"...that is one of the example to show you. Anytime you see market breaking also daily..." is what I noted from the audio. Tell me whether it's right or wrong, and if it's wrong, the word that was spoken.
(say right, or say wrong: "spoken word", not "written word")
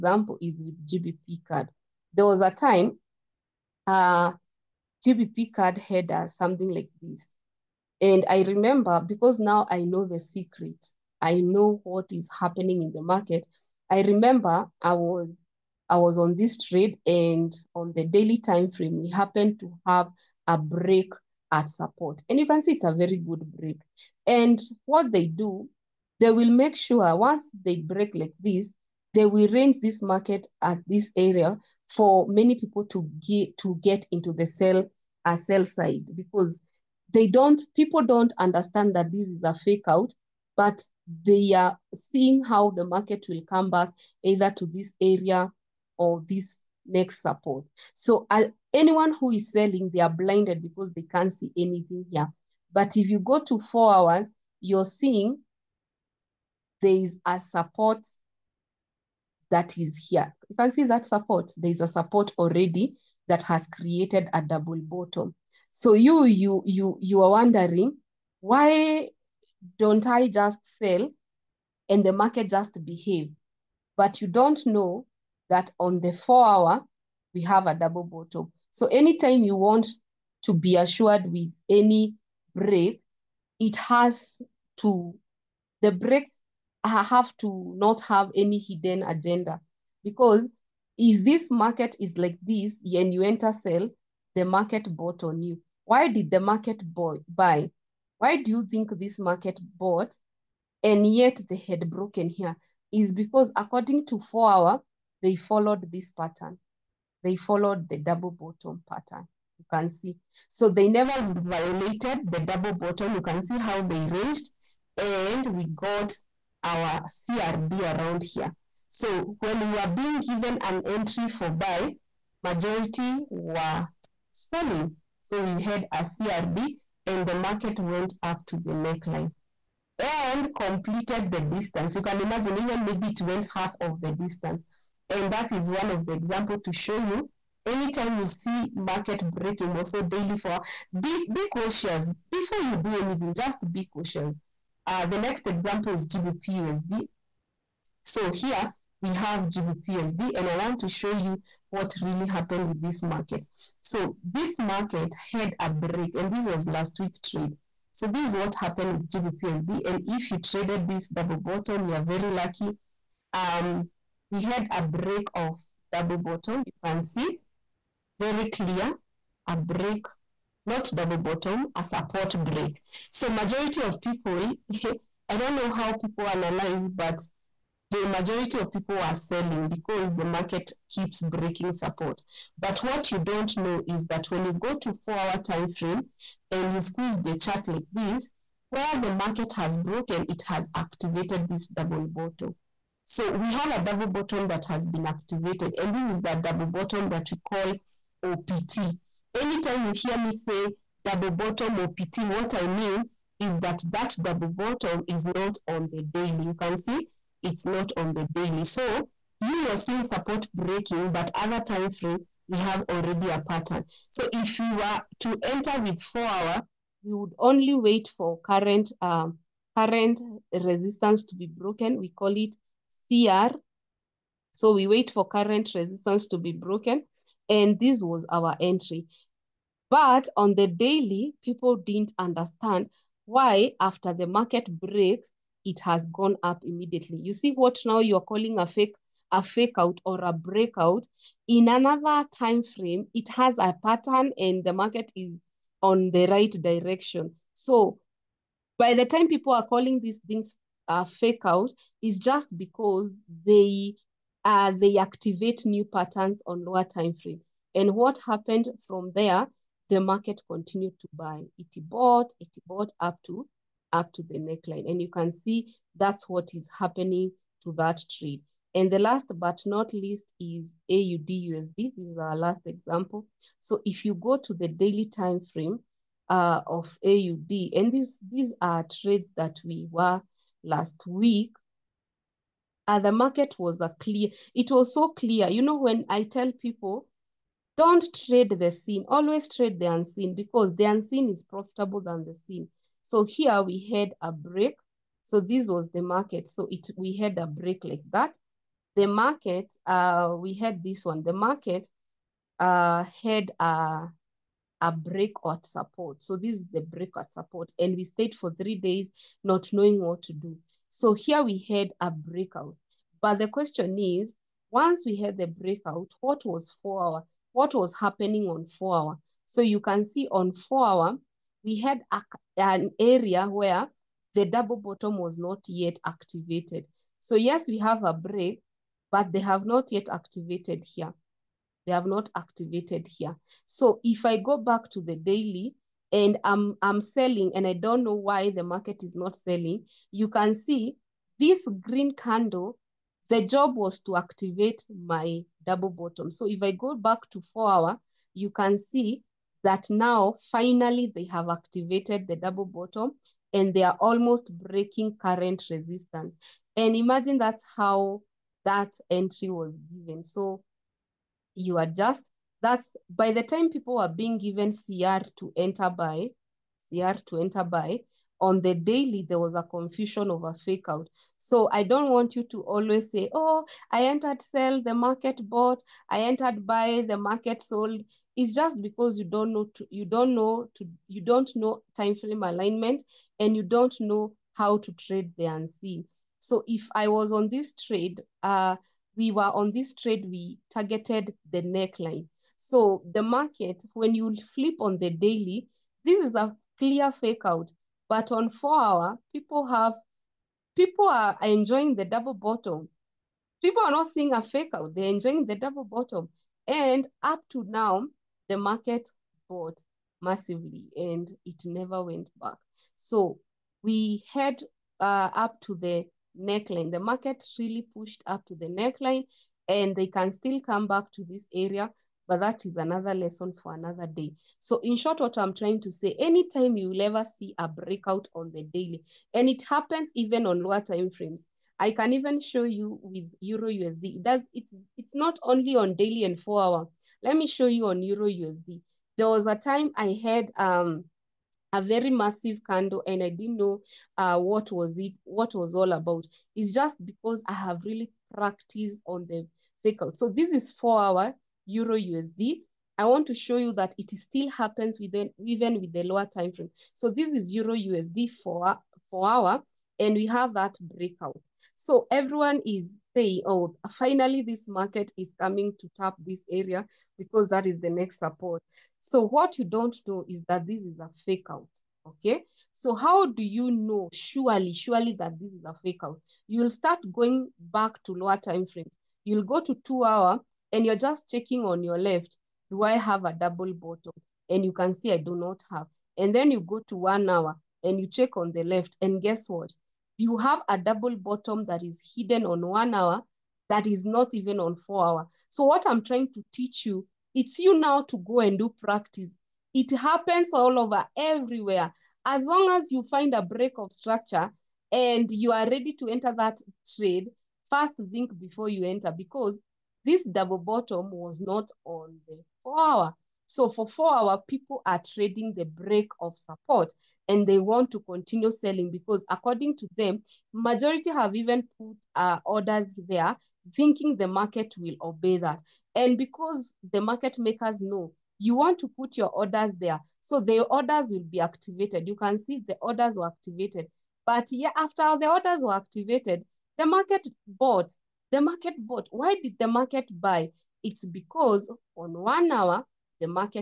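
right.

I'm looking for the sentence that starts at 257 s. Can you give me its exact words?
And what happened from there, the market continued to buy.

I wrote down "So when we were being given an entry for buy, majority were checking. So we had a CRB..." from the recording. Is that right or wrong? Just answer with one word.
wrong.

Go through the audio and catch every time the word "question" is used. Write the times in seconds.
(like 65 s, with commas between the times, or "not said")
313 s.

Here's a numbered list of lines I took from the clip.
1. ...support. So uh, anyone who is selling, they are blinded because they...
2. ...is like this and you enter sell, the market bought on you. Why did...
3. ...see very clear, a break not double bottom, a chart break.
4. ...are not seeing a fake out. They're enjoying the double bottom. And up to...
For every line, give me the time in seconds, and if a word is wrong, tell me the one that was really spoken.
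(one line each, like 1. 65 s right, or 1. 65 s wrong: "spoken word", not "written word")
1. 47 s right
2. 91 s right
3. 167 s wrong: "support", not "chart"
4. 403 s right.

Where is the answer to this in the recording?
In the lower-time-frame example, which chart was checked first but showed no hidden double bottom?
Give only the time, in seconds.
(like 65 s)
479 s.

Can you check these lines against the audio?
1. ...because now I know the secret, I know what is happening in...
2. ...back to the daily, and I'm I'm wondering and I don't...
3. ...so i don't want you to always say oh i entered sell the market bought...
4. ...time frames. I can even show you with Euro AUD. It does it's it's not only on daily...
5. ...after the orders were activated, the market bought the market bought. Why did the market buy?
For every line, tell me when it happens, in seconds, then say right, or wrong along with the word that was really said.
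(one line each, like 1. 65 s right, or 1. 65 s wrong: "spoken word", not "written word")
1. 9 s right
2. 334 s wrong: "selling", not "wondering"
3. 371 s right
4. 430 s wrong: "USD", not "AUD"
5. 534 s right.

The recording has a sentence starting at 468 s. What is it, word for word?
So what you don't know is that this is a fake out, okay?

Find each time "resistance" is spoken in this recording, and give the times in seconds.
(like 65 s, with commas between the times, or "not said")
220 s, 225 s, 355 s.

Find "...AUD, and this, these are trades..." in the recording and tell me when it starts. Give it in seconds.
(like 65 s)
277 s.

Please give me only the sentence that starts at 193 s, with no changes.
So we have a double bottom that has been activated.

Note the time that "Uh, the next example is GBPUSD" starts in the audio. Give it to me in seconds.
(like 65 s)
144 s.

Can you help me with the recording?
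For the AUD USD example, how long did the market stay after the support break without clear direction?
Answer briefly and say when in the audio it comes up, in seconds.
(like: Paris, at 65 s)
three days, at 308 s.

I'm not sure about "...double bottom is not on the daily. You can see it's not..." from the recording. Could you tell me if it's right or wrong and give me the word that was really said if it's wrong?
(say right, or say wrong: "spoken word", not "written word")
right.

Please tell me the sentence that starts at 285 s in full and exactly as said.
You know, when I tell people, don't trade the seen, always trade the unseen because the unseen is profitable than the seen.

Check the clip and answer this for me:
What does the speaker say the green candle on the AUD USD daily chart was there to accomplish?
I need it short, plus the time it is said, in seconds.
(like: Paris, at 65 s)
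activate my double bottom, at 344 s.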